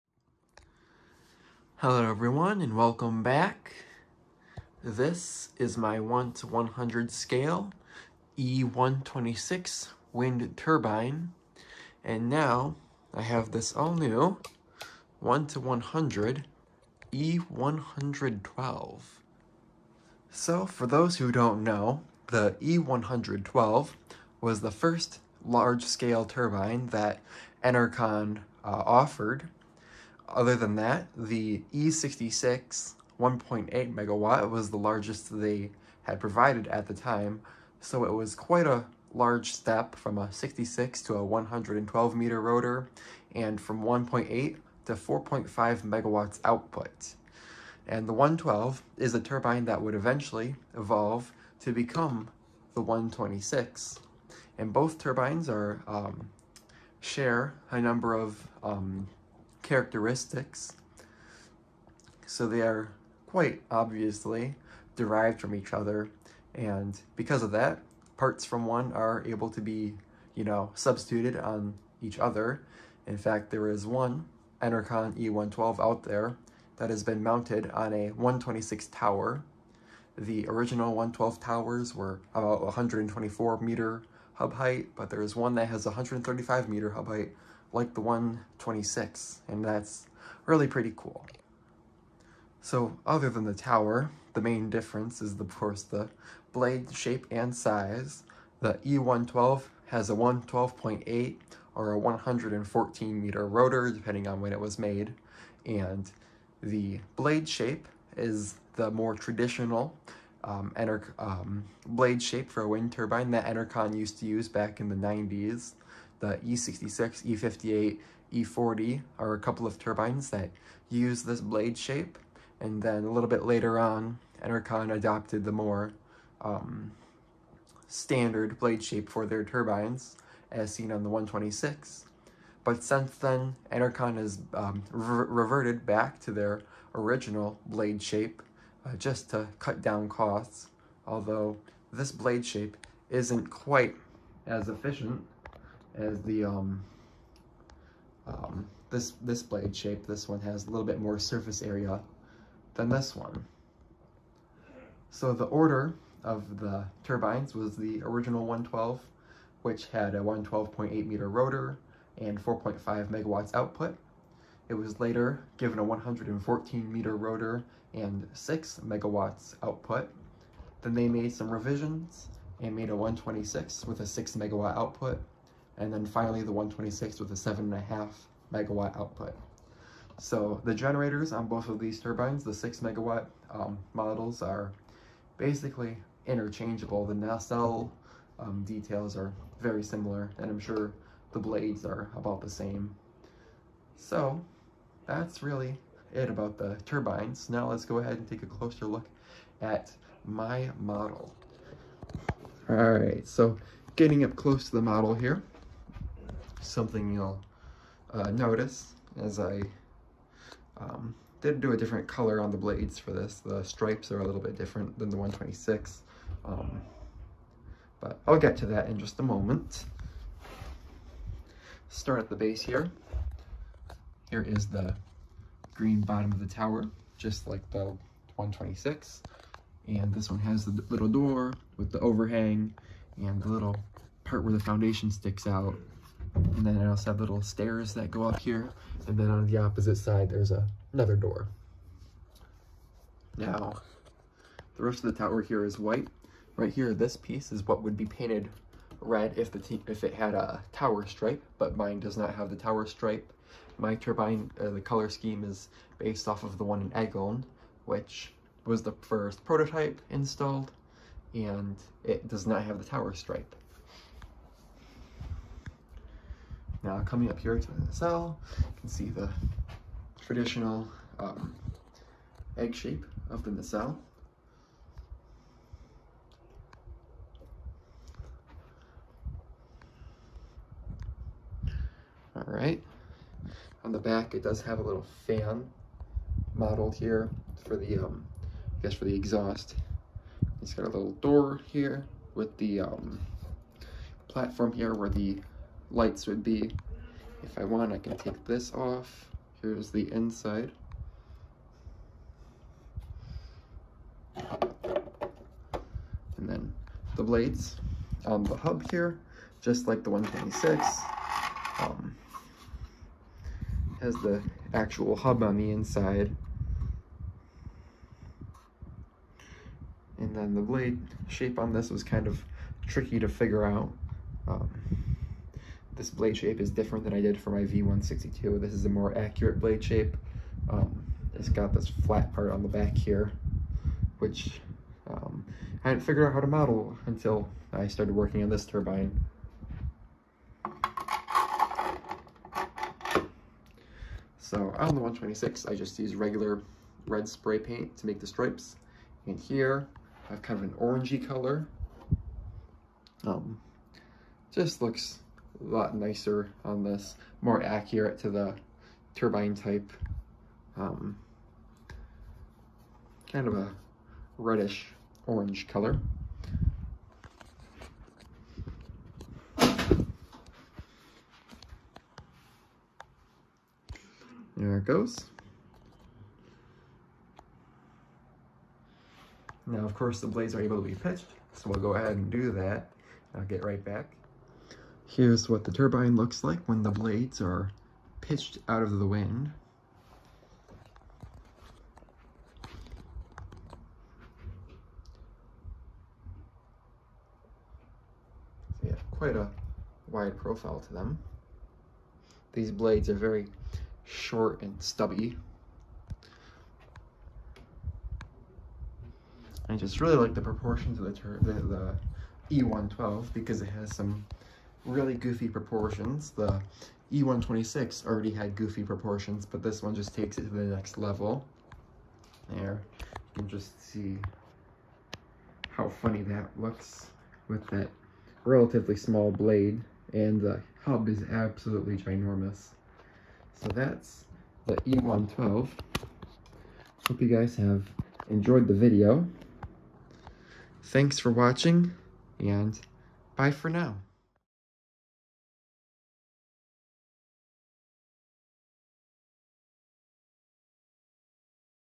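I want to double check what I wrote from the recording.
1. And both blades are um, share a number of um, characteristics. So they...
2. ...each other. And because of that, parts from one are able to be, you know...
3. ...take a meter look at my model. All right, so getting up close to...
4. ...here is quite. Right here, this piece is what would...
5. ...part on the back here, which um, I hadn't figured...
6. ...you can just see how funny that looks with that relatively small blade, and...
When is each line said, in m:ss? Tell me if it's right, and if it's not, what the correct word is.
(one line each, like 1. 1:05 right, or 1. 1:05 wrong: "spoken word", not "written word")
1. 0:54 wrong: "turbines", not "blades"
2. 1:05 right
3. 3:18 wrong: "closer", not "meter"
4. 4:05 wrong: "white", not "quite"
5. 5:32 right
6. 7:03 right.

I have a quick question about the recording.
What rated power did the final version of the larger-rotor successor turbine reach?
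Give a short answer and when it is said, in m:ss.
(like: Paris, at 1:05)
7.5 megawatts, at 2:57.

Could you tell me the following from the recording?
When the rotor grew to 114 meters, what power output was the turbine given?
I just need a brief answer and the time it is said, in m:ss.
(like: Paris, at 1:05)
6 megawatts, at 2:48.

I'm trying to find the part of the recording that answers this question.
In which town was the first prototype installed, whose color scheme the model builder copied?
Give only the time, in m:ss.
4:16.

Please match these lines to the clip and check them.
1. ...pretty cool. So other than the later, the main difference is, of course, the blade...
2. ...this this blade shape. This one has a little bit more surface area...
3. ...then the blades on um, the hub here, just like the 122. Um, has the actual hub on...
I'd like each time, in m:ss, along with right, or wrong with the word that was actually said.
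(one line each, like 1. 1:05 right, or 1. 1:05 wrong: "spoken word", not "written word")
1. 1:30 wrong: "tower", not "later"
2. 2:28 right
3. 5:06 wrong: "126", not "122".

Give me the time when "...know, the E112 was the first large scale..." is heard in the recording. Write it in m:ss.
0:21.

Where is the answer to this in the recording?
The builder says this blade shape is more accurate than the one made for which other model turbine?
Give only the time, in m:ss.
5:27.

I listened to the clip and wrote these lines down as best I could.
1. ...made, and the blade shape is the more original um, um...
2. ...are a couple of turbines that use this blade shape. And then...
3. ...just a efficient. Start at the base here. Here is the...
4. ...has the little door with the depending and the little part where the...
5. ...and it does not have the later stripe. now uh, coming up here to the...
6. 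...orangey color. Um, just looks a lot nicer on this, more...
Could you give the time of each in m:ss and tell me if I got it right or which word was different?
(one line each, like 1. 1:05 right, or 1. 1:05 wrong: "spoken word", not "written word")
1. 1:44 wrong: "traditional", not "original"
2. 1:59 right
3. 3:38 wrong: "moment", not "efficient"
4. 3:50 wrong: "overhang", not "depending"
5. 4:21 wrong: "tower", not "later"
6. 5:50 right.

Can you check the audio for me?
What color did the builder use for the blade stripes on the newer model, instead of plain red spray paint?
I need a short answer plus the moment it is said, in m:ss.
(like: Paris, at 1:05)
reddish orange, at 6:04.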